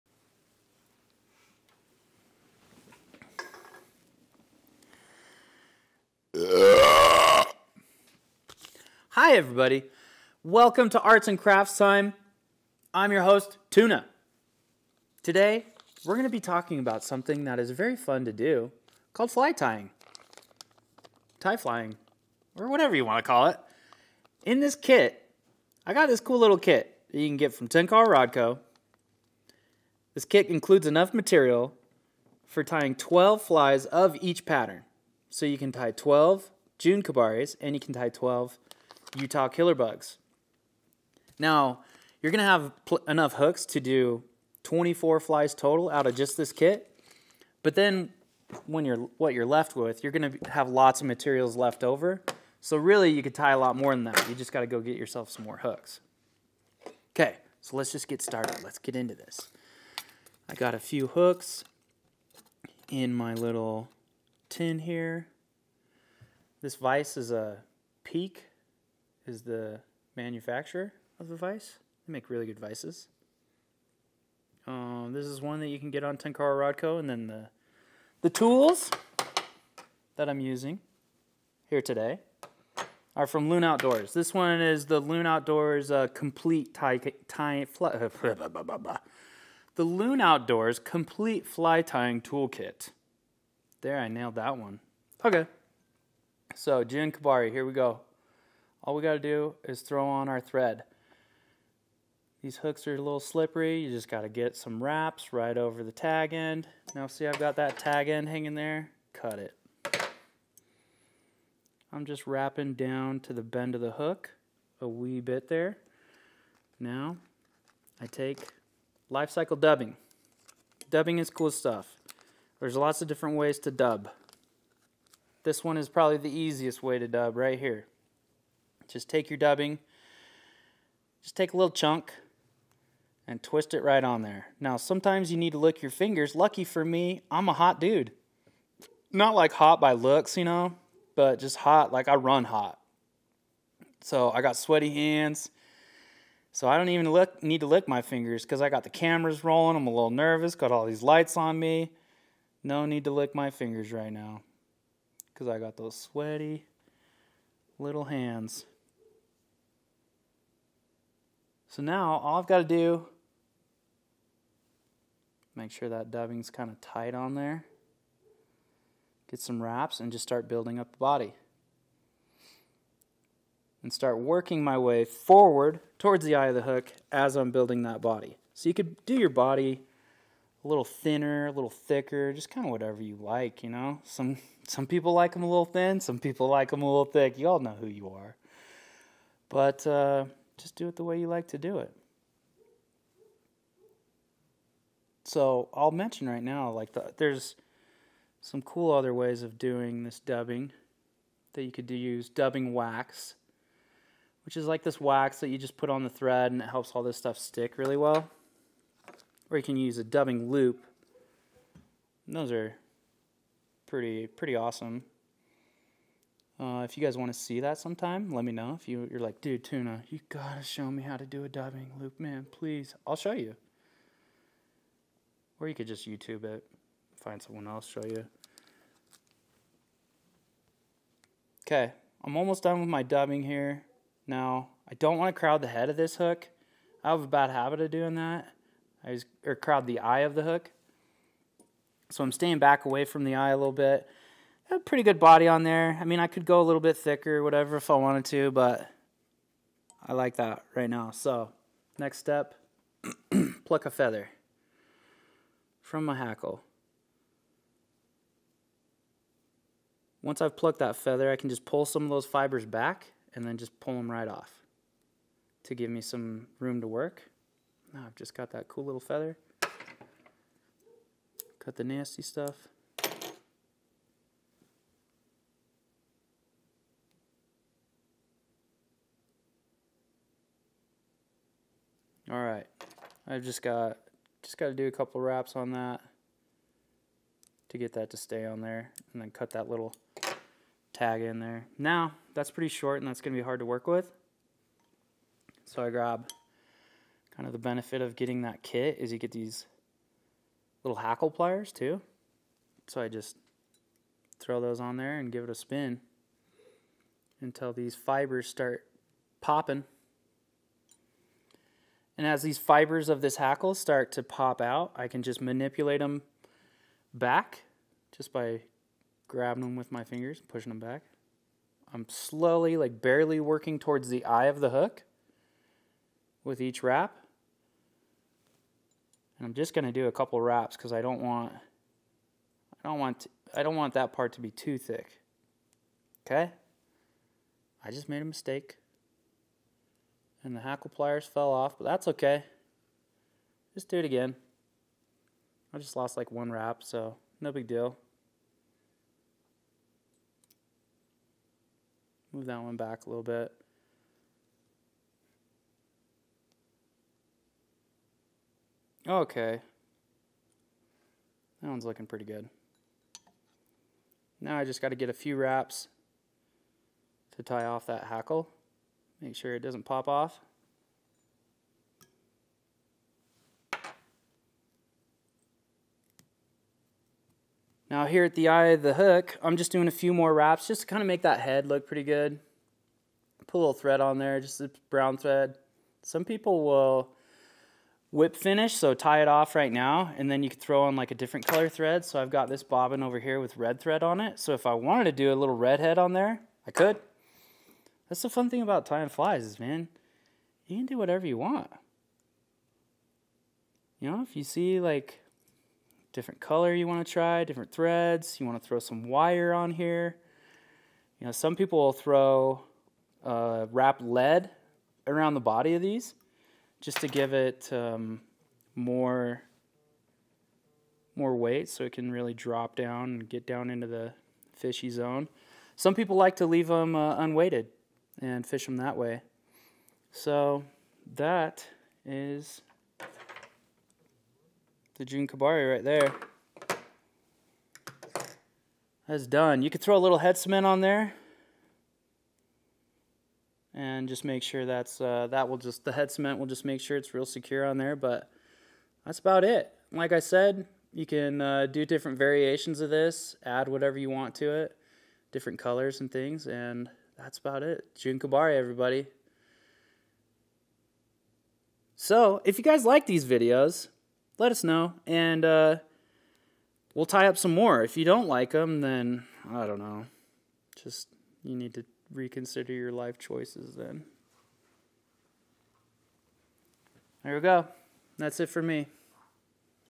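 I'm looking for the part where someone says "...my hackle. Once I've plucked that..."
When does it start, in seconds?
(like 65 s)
256 s.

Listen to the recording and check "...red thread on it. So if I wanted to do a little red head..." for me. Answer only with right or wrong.
right.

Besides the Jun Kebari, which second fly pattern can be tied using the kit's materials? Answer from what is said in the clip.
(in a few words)
Utah Killer Bugs.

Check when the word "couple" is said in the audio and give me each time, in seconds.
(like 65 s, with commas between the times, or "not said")
284 s, 330 s.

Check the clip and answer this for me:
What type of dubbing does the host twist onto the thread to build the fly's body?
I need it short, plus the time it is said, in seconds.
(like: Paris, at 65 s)
life cycle dubbing, at 119 s.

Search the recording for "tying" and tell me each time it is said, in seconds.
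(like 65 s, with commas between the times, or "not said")
19 s, 32 s, 91 s, 398 s.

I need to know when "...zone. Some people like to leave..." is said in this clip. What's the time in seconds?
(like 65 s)
424 s.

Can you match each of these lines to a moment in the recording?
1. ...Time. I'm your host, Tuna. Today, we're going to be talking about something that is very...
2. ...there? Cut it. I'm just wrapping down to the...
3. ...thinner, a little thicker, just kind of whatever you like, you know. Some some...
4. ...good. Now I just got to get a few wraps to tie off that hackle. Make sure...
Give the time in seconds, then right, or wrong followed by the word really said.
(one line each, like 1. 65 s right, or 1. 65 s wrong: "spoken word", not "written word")
1. 11 s right
2. 108 s right
3. 180 s right
4. 362 s right.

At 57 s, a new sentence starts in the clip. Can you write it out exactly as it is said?
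Okay, so let's just get started.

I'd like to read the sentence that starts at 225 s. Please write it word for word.
Or you could just YouTube it, find someone else, show you.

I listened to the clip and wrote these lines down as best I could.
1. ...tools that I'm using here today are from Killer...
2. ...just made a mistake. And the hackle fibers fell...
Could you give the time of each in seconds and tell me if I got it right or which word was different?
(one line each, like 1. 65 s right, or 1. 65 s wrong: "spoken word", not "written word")
1. 78 s wrong: "Loon", not "Killer"
2. 337 s wrong: "pliers", not "fibers".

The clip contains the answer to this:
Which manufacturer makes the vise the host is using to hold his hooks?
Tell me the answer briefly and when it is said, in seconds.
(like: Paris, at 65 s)
Peak, at 68 s.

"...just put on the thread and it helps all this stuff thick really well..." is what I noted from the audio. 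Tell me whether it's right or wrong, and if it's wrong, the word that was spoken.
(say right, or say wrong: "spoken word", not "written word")
wrong: "stick", not "thick".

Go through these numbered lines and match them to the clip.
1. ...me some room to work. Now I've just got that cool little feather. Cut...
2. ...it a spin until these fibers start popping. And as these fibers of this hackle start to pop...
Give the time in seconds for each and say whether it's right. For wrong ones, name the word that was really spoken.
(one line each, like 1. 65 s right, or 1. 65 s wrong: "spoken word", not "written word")
1. 265 s right
2. 305 s right.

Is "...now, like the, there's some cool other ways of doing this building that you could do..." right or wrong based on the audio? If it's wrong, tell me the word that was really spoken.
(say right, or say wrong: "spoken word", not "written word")
wrong: "dubbing", not "building".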